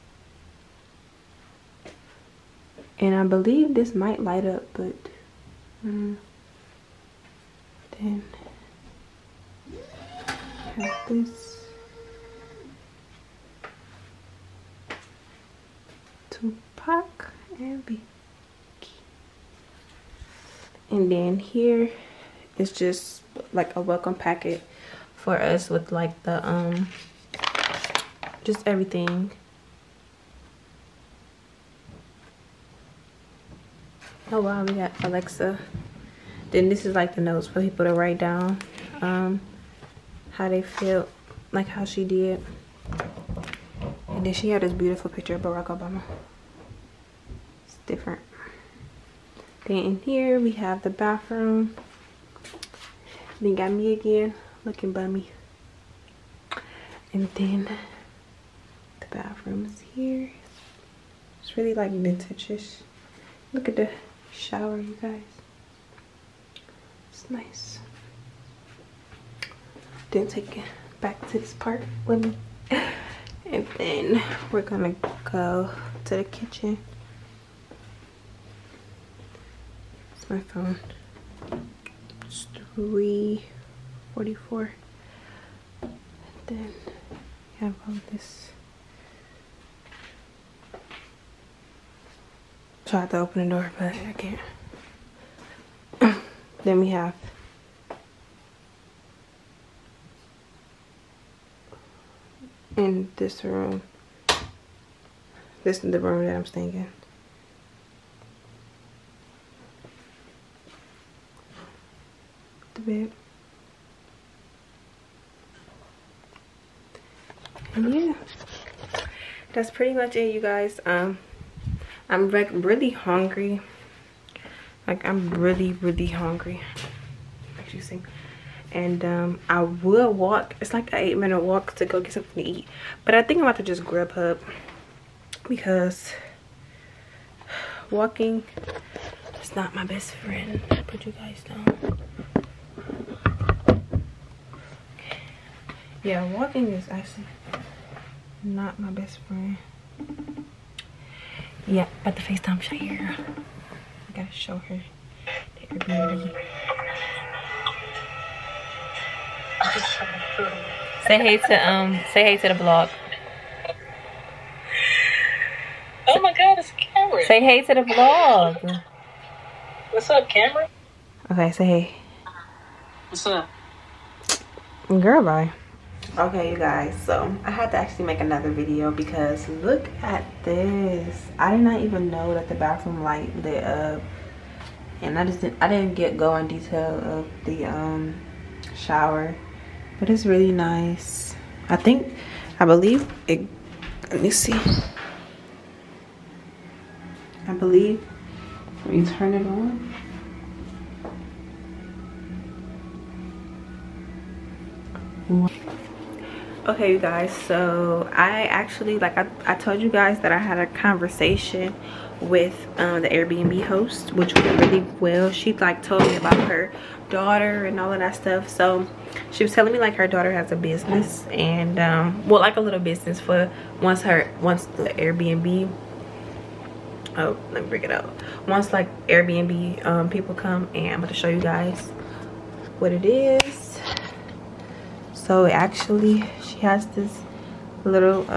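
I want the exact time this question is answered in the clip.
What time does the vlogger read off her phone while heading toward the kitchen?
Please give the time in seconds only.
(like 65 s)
82 s.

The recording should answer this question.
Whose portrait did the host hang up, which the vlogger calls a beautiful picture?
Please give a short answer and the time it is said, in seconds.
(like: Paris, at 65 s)
Barack Obama, at 45 s.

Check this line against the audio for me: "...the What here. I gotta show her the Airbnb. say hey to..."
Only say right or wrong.
wrong.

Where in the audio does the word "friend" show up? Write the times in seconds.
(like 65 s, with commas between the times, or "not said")
140 s, 149 s.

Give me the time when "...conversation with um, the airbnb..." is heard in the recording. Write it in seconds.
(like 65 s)
210 s.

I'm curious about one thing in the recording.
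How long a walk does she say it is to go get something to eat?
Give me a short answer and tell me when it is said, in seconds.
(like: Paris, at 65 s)
8 minutes, at 130 s.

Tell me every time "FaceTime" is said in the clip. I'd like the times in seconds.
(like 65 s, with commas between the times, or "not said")
152 s.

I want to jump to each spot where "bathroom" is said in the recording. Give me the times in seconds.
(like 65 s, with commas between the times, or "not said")
50 s, 59 s, 182 s.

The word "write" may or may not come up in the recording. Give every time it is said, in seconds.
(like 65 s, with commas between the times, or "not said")
37 s.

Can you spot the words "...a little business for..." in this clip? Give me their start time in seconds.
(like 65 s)
222 s.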